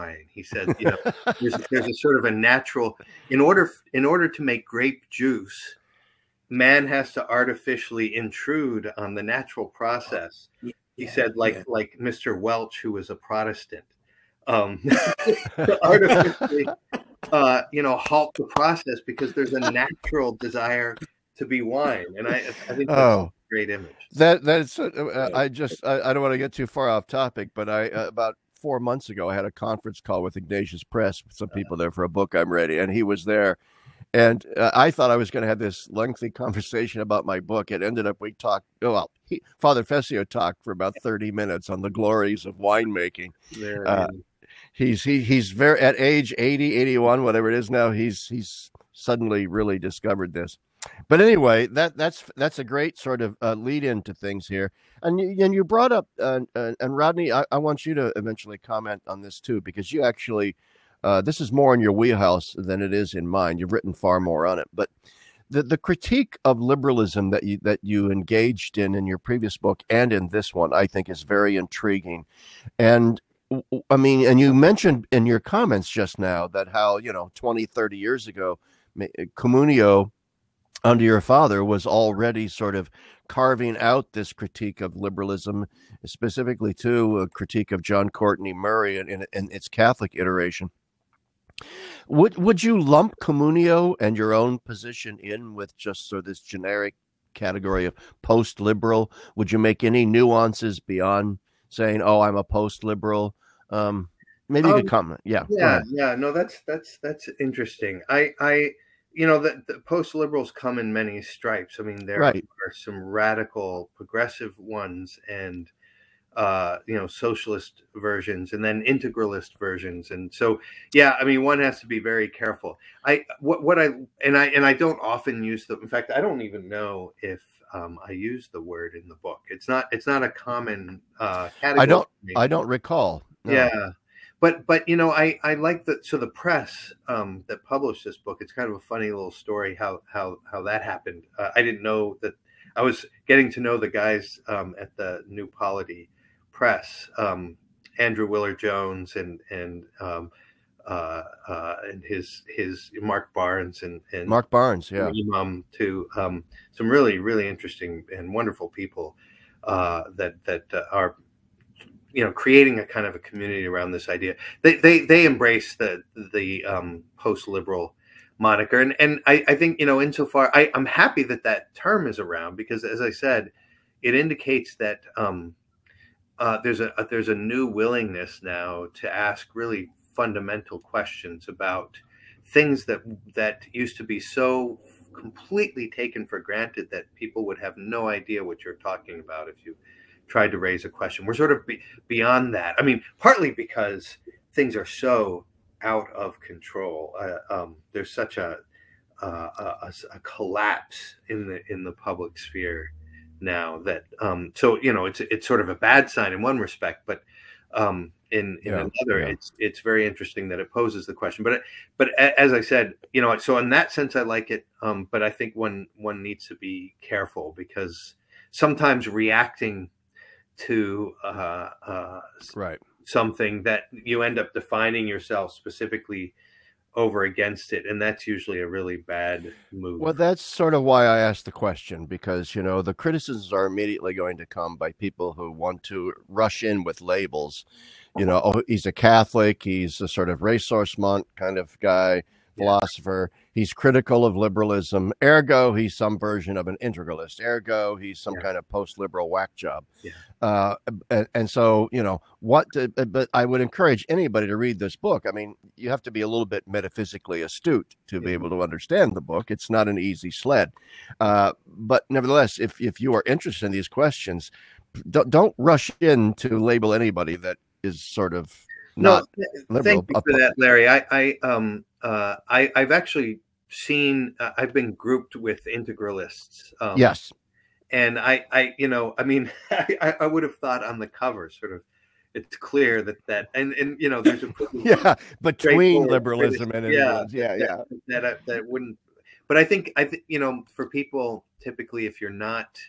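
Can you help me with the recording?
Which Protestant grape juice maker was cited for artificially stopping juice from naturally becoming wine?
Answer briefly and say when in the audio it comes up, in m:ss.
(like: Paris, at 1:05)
Mr Welch, at 0:11.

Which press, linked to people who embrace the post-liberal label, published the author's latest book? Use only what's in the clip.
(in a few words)
New Polity Press.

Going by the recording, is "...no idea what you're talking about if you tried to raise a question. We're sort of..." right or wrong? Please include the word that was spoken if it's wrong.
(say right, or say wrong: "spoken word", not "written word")
right.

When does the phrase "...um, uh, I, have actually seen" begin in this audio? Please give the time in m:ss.
4:31.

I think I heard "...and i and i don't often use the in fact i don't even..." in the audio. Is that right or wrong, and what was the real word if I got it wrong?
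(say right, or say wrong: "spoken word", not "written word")
right.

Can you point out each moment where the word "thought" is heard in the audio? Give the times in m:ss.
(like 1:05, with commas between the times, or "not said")
0:34, 4:40.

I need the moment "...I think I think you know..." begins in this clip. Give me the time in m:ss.
4:49.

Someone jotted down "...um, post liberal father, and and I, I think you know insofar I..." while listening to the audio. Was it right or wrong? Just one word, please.
wrong.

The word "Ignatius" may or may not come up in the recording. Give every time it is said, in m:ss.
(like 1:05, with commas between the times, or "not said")
0:30.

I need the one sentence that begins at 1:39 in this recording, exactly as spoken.
Would you make any nuances beyond saying, "Oh, I'm a post liberal"?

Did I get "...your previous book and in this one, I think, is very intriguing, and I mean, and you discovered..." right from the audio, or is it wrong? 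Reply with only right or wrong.
wrong.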